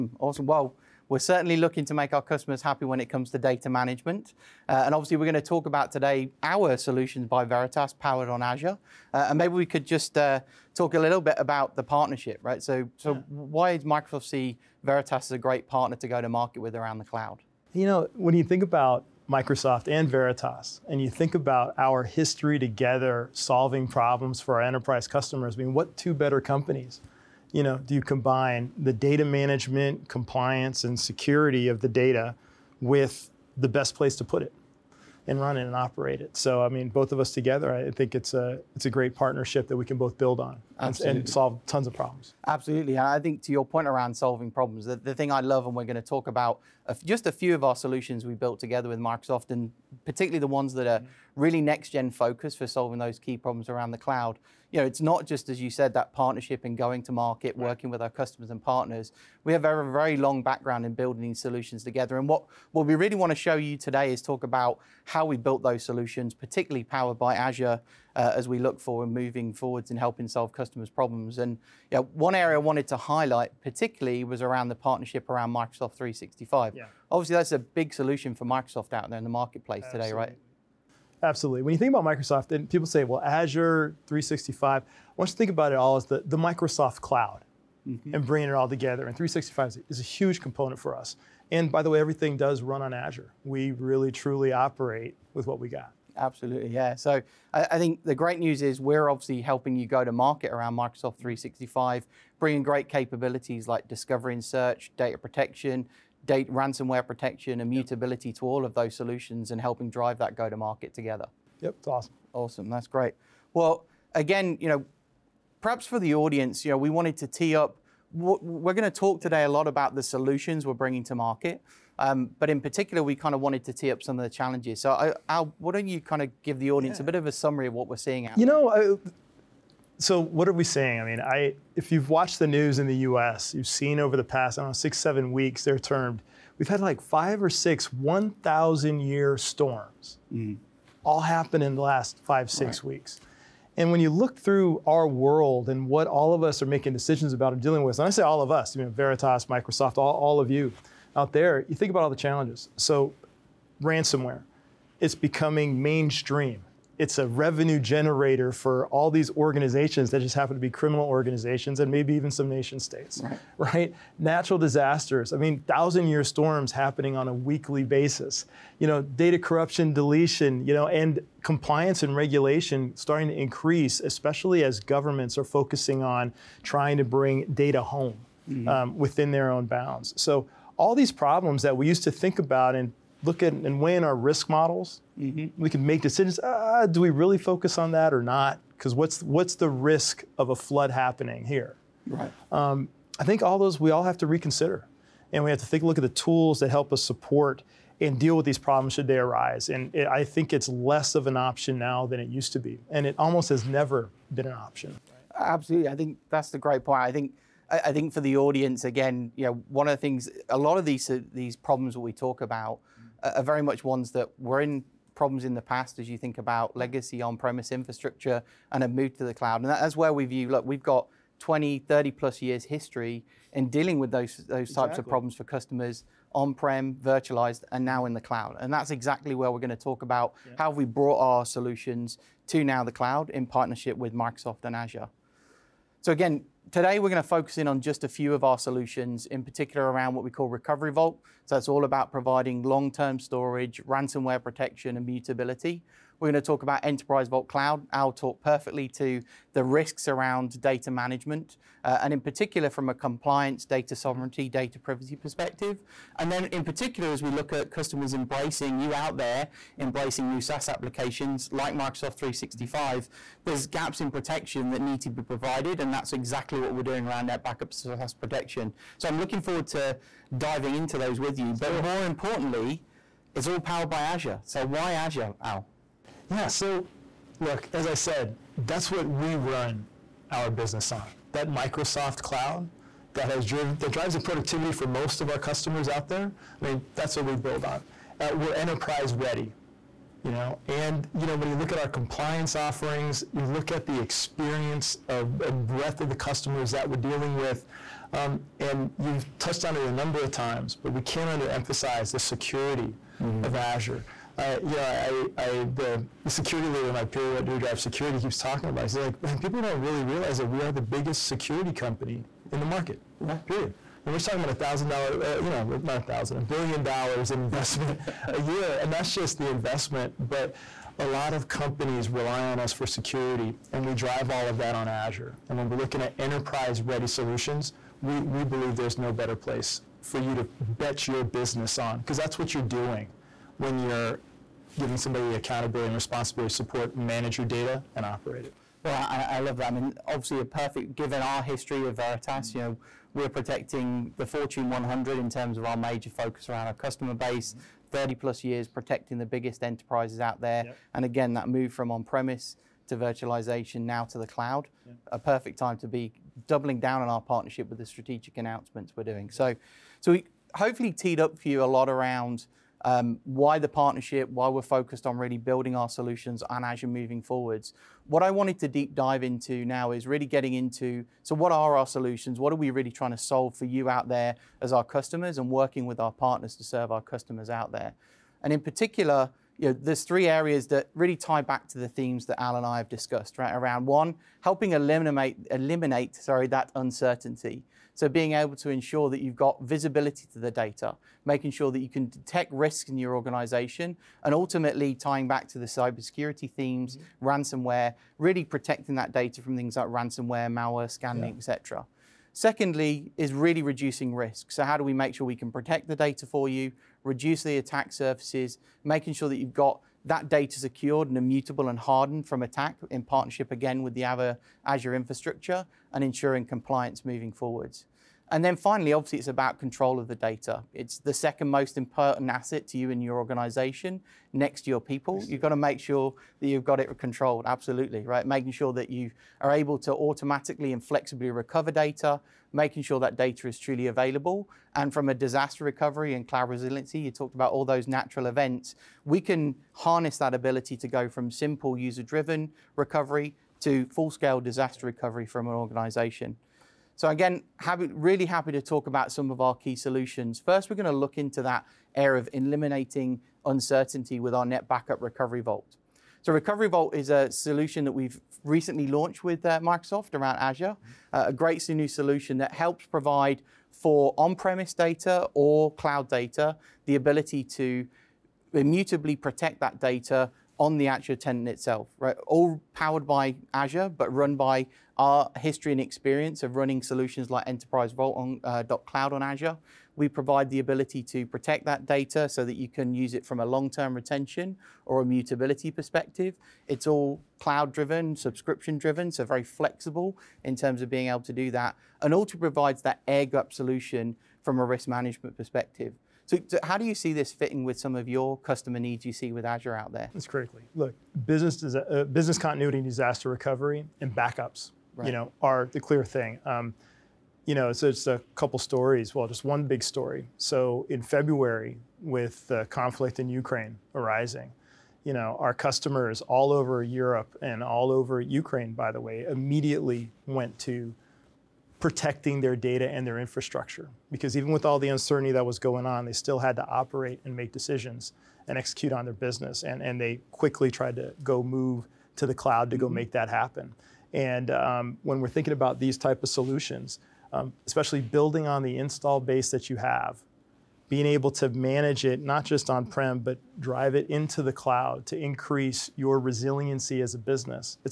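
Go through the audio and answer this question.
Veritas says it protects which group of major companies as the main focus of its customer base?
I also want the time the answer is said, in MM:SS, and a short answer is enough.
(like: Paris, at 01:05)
Fortune 100, at 05:44.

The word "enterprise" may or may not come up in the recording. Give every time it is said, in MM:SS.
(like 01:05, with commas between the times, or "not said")
00:24, 04:06, 04:48, 05:26, 05:49, 07:57.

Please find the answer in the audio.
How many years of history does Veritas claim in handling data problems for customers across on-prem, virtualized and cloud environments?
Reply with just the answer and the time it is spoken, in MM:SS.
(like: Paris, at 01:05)
20, 30 plus years, at 03:41.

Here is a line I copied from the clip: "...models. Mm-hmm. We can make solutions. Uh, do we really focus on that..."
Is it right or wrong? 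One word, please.
wrong.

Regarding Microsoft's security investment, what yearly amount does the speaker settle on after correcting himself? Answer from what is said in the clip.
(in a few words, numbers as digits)
a billion dollars.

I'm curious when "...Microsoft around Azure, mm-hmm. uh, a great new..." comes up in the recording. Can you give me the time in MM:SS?
07:39.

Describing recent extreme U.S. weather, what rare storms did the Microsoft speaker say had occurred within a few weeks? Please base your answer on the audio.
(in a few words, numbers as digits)
1,000 year storms.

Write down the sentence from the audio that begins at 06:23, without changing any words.
Around one, helping eliminate, eliminate sorry, that uncertainty.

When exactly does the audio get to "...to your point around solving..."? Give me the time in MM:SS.
00:43.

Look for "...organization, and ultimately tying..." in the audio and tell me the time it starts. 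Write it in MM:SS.
06:33.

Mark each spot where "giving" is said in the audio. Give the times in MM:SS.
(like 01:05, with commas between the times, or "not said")
05:34.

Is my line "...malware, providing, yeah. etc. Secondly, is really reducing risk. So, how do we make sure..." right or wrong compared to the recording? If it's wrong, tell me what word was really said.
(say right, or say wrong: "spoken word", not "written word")
wrong: "scanning", not "providing".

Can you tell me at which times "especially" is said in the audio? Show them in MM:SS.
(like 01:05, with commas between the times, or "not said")
02:53, 08:57.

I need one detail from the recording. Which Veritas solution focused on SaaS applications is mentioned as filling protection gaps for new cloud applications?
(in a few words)
NetBackup SaaS protection.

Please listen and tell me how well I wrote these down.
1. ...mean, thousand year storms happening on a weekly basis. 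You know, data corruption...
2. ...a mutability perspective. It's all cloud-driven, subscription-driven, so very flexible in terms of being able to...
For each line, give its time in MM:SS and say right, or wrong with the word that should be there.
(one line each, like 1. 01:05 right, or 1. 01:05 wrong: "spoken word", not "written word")
1. 02:45 right
2. 08:05 right.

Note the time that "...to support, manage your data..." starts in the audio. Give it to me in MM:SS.
05:36.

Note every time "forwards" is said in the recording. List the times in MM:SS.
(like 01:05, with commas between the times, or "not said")
01:09, 04:29, 06:07, 06:57.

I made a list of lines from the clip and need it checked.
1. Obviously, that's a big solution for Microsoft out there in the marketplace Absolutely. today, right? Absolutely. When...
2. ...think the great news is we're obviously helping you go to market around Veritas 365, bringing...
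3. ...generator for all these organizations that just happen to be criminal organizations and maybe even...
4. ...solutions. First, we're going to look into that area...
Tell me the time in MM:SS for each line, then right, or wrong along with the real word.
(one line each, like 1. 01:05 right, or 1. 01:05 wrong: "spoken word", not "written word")
1. 01:17 right
2. 01:37 wrong: "Microsoft", not "Veritas"
3. 02:37 right
4. 07:29 right.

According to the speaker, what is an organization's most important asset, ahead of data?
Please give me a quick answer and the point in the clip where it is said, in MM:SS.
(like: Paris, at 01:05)
your people, at 07:04.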